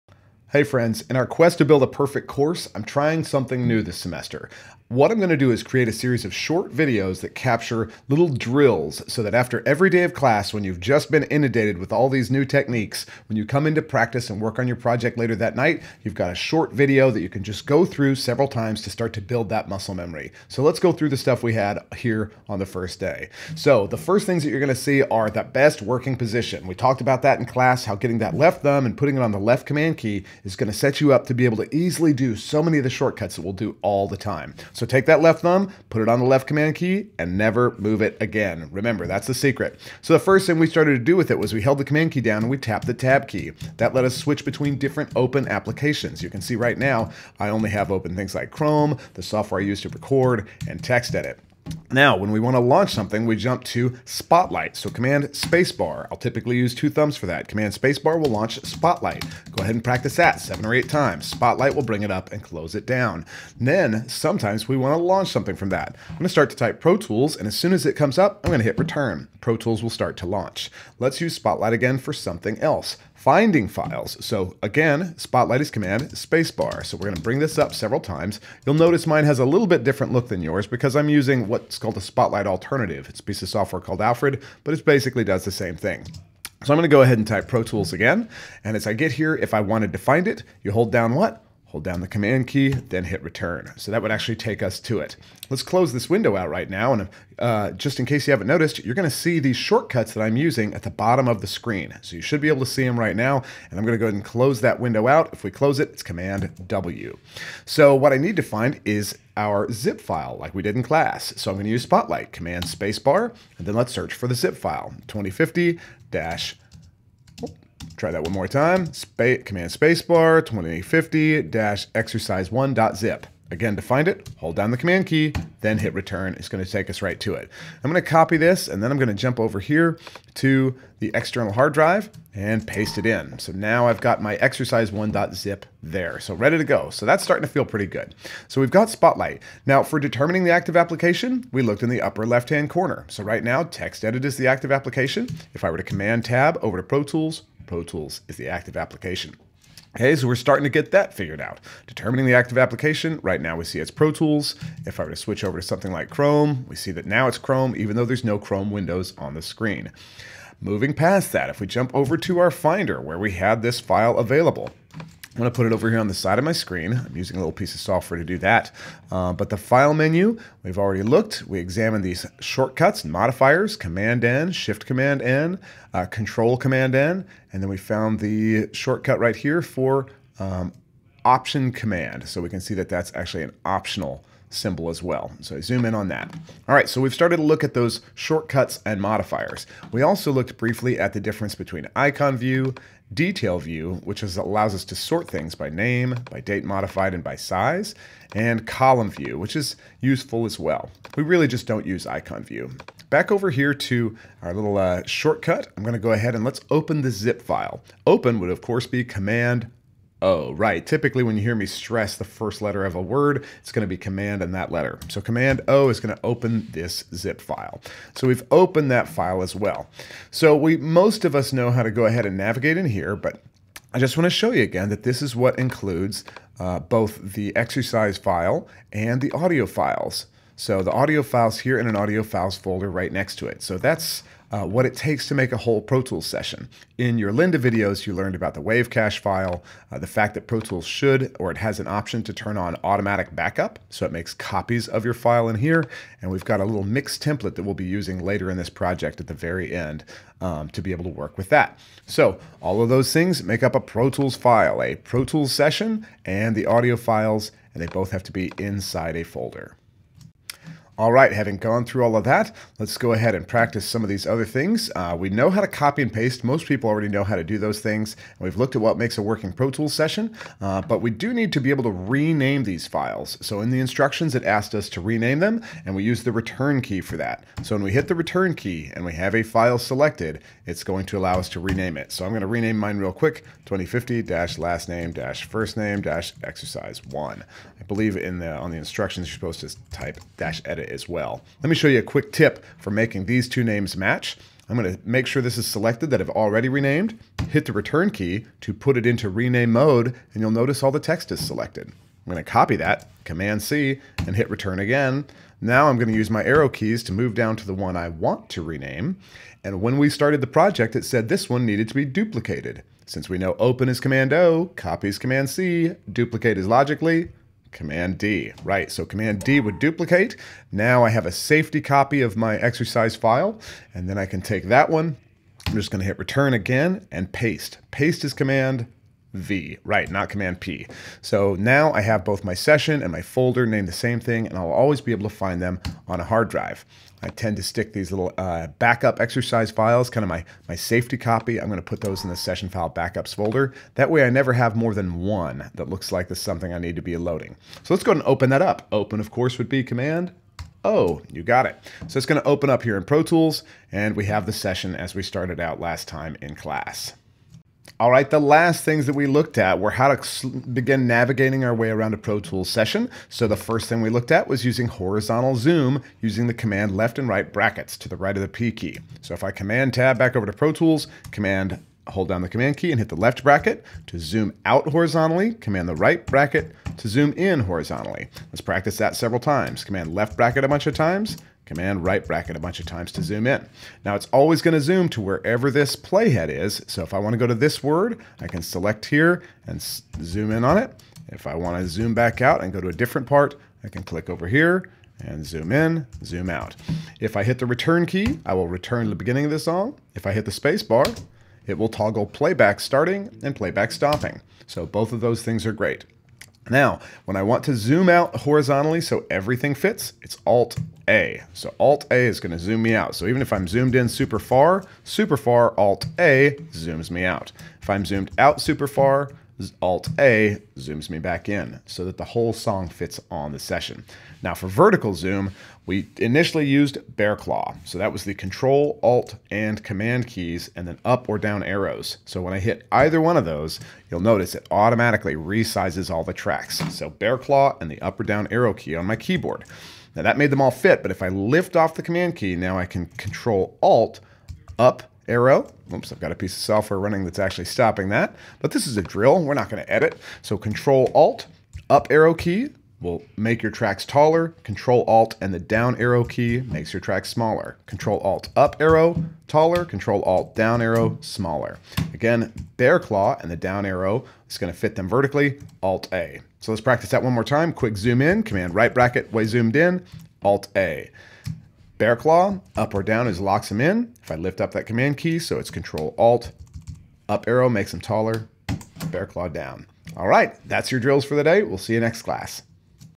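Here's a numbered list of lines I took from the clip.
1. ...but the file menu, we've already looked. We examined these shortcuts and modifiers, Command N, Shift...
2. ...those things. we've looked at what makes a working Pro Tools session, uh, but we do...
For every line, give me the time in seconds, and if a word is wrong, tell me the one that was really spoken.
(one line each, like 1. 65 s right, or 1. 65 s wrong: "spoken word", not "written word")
1. 169 s right
2. 267 s right.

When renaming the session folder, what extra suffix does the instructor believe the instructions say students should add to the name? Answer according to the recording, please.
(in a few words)
dash edit.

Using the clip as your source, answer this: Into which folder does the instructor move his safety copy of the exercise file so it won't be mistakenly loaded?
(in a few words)
session file backups.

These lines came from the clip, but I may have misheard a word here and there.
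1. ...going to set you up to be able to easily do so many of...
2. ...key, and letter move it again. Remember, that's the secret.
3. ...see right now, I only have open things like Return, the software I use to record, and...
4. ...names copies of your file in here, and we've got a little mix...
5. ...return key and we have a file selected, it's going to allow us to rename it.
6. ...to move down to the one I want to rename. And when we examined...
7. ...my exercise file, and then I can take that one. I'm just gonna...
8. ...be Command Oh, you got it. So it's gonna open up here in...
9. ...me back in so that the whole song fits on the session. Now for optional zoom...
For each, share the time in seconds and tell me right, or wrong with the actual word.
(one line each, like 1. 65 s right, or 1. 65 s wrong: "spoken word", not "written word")
1. 30 s right
2. 36 s wrong: "never", not "letter"
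3. 46 s wrong: "Chrome", not "Return"
4. 244 s wrong: "makes", not "names"
5. 278 s right
6. 307 s wrong: "started", not "examined"
7. 322 s right
8. 349 s right
9. 421 s wrong: "vertical", not "optional".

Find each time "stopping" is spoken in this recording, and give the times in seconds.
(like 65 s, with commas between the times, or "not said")
403 s, 447 s.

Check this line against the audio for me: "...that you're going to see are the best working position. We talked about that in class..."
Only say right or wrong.
right.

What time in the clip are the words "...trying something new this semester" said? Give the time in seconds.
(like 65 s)
2 s.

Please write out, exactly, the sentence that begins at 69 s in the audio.
Pro Tools will start to launch.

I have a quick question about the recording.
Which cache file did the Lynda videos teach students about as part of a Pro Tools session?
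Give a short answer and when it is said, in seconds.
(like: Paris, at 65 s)
wave cache file, at 238 s.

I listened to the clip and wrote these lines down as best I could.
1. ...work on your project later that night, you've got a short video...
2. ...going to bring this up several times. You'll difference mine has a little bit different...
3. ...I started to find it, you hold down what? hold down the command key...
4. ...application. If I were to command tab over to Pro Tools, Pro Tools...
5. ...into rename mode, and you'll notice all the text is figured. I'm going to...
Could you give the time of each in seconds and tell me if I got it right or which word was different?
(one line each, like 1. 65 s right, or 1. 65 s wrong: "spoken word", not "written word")
1. 14 s right
2. 77 s wrong: "notice", not "difference"
3. 89 s wrong: "wanted", not "started"
4. 144 s right
5. 299 s wrong: "selected", not "figured".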